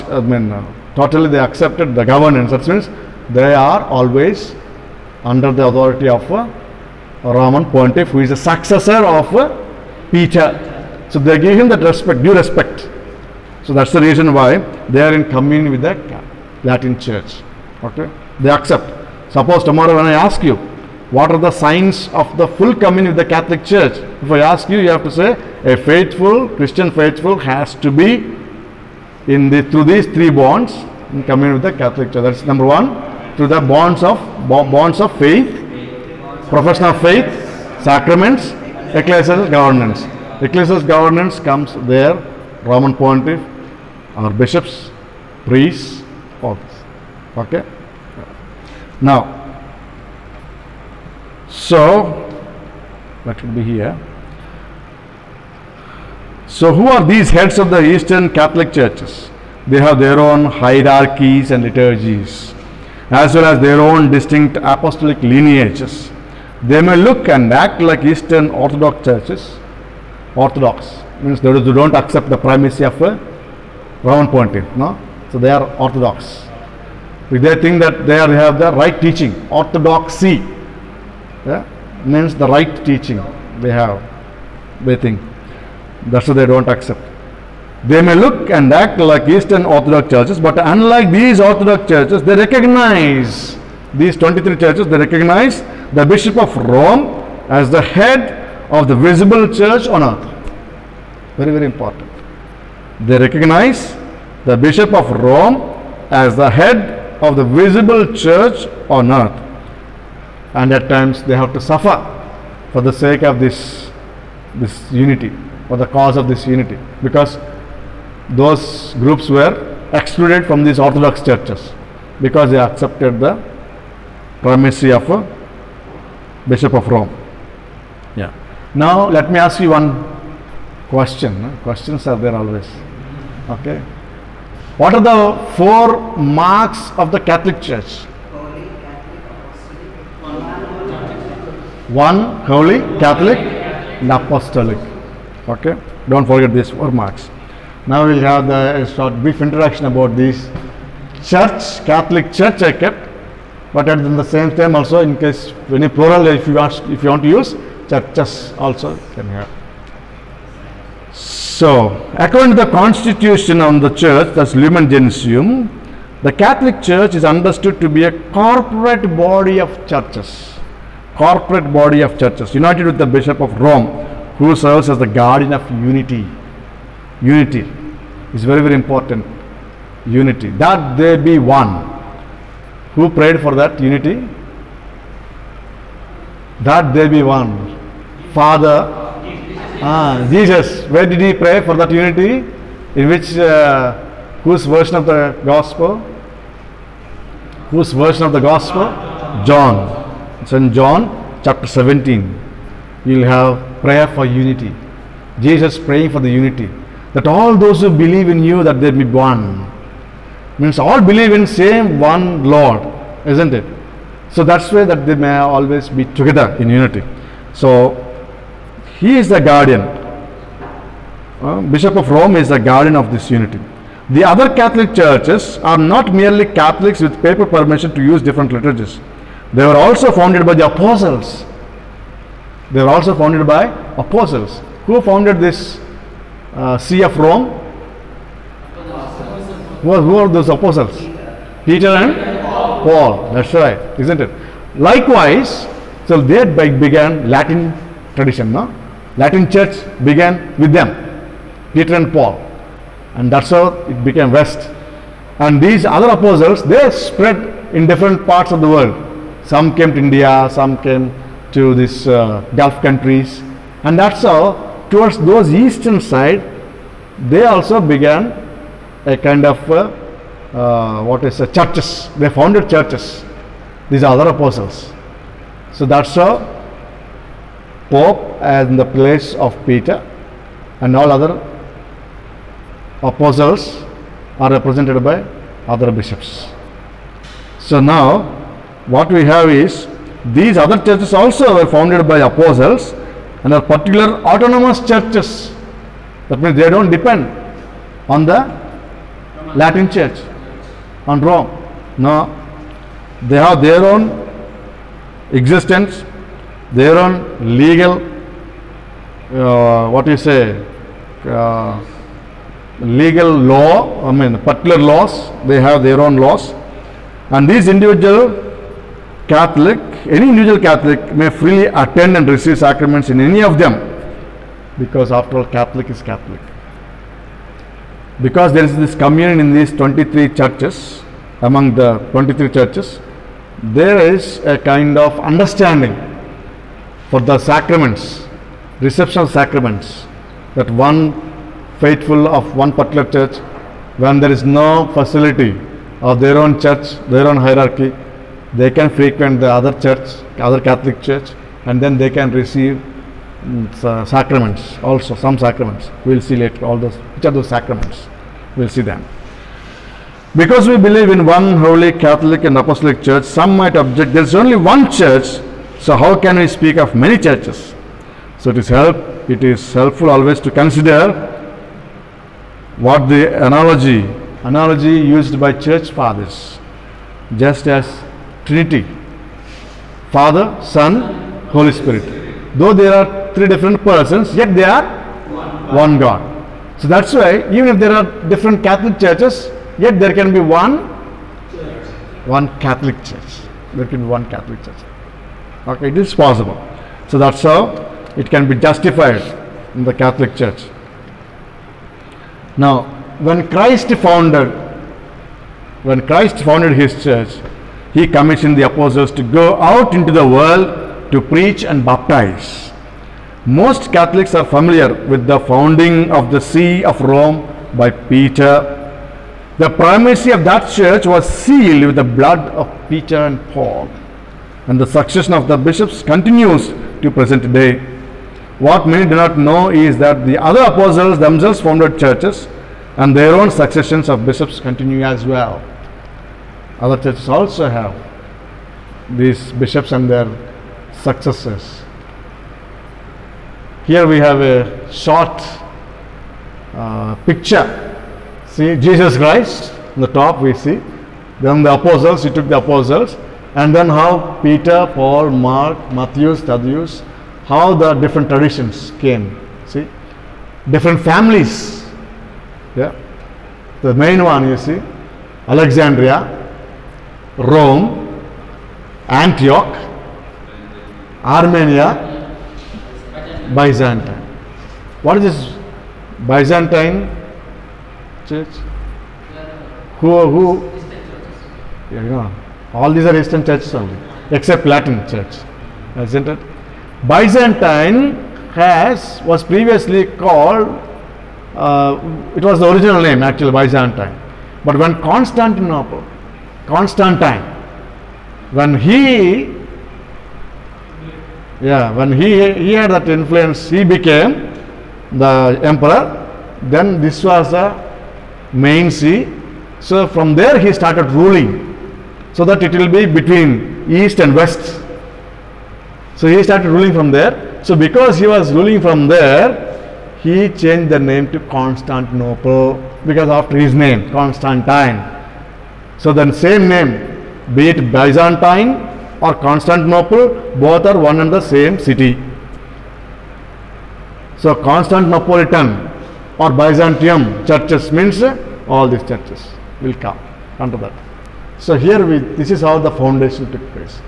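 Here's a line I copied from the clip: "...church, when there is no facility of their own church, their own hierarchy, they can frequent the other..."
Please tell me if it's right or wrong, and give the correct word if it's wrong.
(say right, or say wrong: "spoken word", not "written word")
right.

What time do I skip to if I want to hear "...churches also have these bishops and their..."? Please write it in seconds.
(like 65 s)
437 s.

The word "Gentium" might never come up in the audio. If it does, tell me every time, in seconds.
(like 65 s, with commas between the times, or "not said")
164 s.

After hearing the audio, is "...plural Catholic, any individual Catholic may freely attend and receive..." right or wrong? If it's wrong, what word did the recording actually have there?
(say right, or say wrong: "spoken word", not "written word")
wrong: "individual", not "plural".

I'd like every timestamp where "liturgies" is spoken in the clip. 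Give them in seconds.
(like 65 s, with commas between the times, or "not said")
61 s, 228 s.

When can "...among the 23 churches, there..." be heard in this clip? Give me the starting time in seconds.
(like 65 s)
331 s.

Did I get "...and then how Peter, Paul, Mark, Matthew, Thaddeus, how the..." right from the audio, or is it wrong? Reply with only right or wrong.
right.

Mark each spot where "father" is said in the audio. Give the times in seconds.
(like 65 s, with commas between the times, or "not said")
188 s, 375 s, 380 s.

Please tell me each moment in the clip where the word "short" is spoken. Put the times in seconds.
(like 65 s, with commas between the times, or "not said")
148 s, 444 s.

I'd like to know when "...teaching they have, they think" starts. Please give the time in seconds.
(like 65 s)
82 s.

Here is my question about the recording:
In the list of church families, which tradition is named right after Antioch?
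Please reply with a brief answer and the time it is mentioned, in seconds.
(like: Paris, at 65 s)
Armenia, at 471 s.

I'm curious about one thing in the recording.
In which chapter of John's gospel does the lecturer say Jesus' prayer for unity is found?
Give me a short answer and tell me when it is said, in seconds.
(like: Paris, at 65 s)
Chapter 17, at 201 s.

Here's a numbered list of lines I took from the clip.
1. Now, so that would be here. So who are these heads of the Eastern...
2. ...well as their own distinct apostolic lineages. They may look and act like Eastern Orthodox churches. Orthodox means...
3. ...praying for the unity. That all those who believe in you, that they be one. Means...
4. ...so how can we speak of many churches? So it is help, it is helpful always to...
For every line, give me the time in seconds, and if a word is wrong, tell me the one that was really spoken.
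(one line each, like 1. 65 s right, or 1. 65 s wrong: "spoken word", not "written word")
1. 48 s right
2. 63 s right
3. 205 s right
4. 365 s right.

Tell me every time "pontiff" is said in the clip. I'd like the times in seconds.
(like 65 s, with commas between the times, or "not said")
7 s, 42 s, 74 s.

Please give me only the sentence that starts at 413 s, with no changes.
Most Catholics are familiar with the founding of the See of Rome by Peter.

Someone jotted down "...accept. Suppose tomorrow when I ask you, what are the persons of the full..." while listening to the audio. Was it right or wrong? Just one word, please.
wrong.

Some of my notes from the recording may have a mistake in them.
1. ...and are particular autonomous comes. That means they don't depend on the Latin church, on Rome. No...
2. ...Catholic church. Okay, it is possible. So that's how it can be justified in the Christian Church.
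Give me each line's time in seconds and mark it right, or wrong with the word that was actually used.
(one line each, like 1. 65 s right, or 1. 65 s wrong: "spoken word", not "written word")
1. 293 s wrong: "churches", not "comes"
2. 394 s wrong: "Catholic", not "Christian".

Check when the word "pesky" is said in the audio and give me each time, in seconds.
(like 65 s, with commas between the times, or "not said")
not said.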